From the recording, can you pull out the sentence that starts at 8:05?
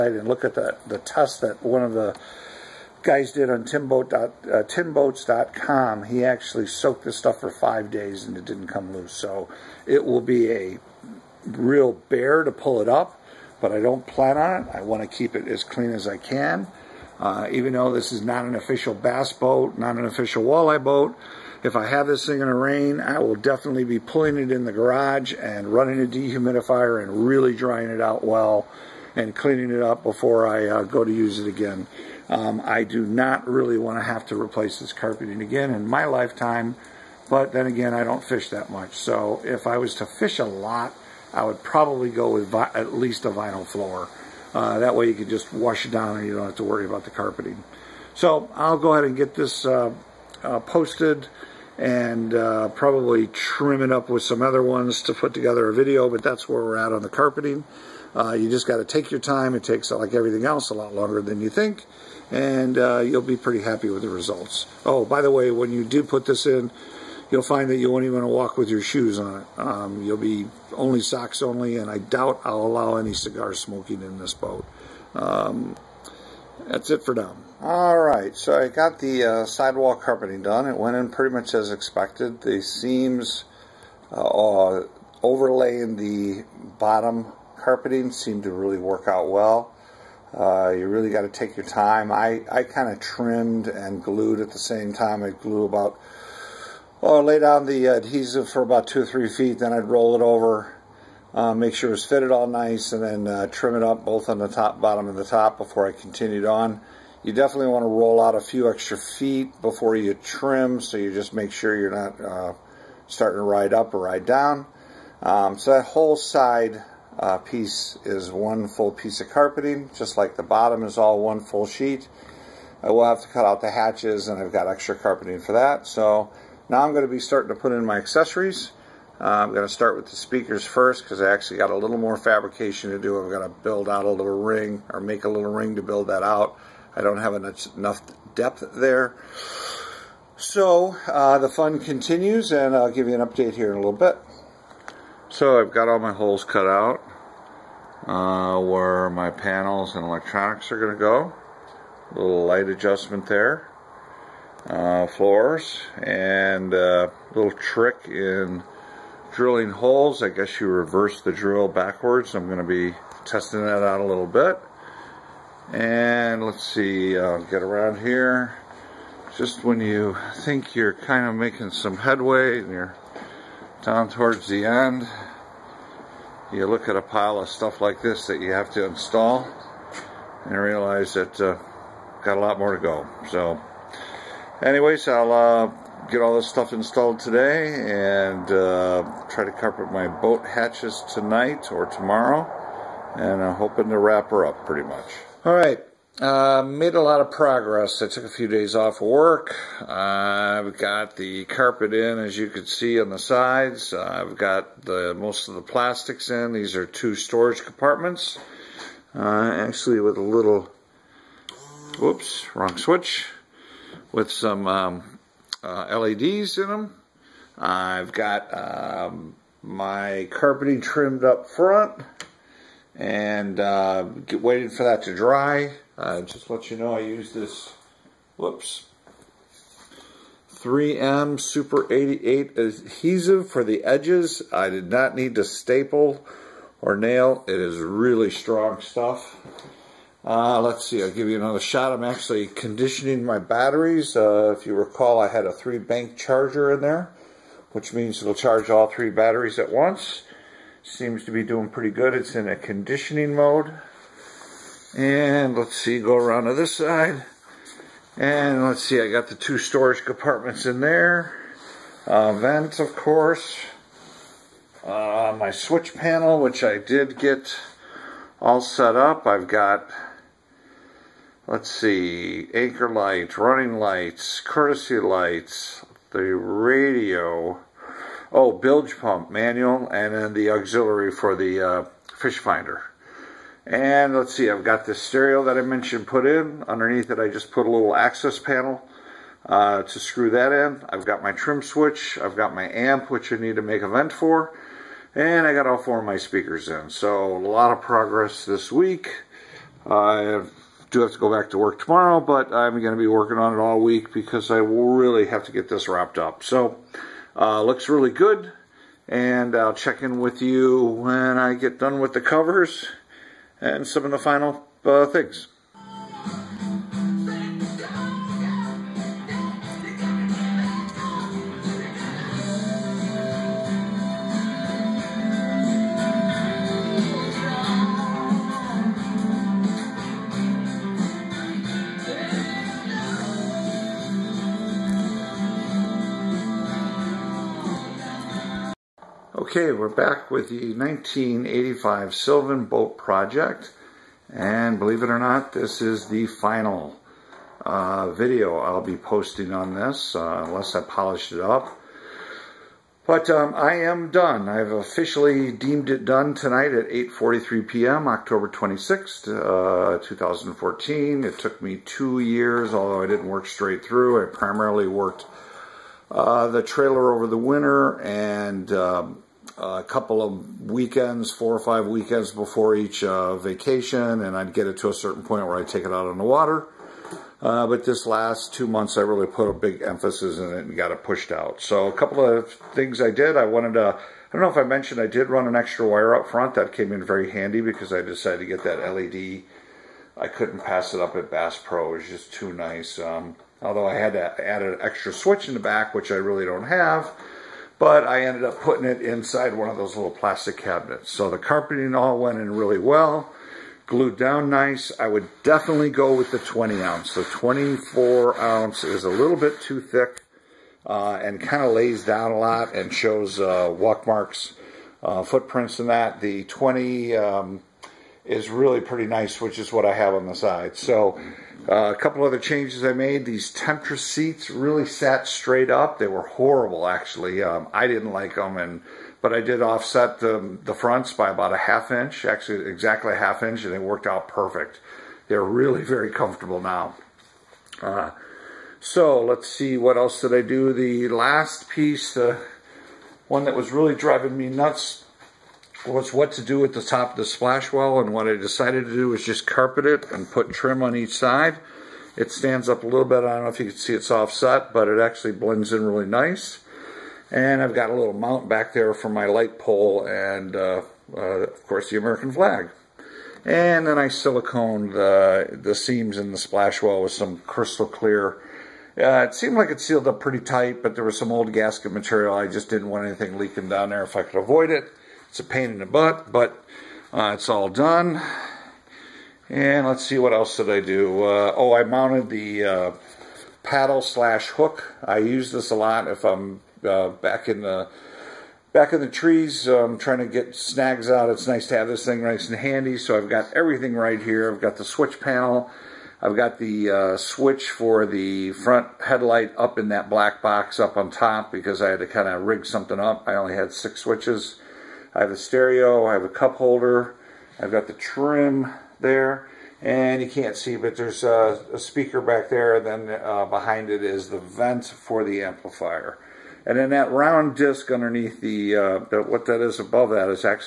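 I use this a lot if I'm uh, back in the back in the trees um, trying to get snags out.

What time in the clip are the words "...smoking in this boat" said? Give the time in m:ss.
1:13.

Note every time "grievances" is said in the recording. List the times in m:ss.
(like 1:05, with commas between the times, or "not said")
not said.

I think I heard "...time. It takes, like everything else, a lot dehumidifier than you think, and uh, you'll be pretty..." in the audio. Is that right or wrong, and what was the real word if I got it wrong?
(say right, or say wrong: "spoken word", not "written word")
wrong: "longer", not "dehumidifier".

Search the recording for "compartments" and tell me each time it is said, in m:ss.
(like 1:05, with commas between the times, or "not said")
3:27, 4:20.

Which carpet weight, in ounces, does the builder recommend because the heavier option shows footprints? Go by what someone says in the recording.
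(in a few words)
20 ounce.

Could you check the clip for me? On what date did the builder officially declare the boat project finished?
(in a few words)
October 26th, 2014.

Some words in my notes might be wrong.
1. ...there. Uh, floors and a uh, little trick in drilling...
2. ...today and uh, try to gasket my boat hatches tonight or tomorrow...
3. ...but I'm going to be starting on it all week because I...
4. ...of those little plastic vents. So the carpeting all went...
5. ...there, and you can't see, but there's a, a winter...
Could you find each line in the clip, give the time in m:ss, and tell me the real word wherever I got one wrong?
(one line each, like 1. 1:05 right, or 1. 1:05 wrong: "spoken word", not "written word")
1. 2:33 right
2. 3:07 wrong: "carpet", not "gasket"
3. 5:02 wrong: "working", not "starting"
4. 6:39 wrong: "cabinets", not "vents"
5. 8:29 wrong: "speaker", not "winter".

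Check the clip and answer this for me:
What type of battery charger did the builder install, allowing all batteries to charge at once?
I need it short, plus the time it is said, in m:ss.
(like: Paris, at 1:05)
three bank charger, at 4:05.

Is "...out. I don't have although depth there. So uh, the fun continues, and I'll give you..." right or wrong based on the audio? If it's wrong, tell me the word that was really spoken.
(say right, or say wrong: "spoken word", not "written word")
wrong: "enough", not "although".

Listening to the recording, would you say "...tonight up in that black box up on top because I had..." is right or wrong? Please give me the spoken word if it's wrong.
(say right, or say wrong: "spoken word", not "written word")
wrong: "headlight", not "tonight".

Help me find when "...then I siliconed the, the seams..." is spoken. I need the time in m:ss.
7:43.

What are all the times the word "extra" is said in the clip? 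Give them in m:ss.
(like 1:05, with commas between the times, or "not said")
1:48, 2:04, 6:25, 6:34.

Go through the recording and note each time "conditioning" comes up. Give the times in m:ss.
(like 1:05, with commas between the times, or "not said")
4:02, 4:12.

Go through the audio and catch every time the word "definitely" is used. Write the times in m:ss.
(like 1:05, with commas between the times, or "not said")
0:23, 1:47, 6:45.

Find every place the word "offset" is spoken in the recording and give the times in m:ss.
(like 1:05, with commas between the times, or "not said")
7:09, 7:34.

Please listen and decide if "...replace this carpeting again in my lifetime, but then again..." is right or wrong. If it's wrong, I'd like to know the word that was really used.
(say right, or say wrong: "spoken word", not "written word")
right.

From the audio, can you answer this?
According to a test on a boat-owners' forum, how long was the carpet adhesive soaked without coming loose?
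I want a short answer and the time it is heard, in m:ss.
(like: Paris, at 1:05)
5 days, at 0:07.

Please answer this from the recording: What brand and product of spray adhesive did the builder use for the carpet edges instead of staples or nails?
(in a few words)
3M Super 88.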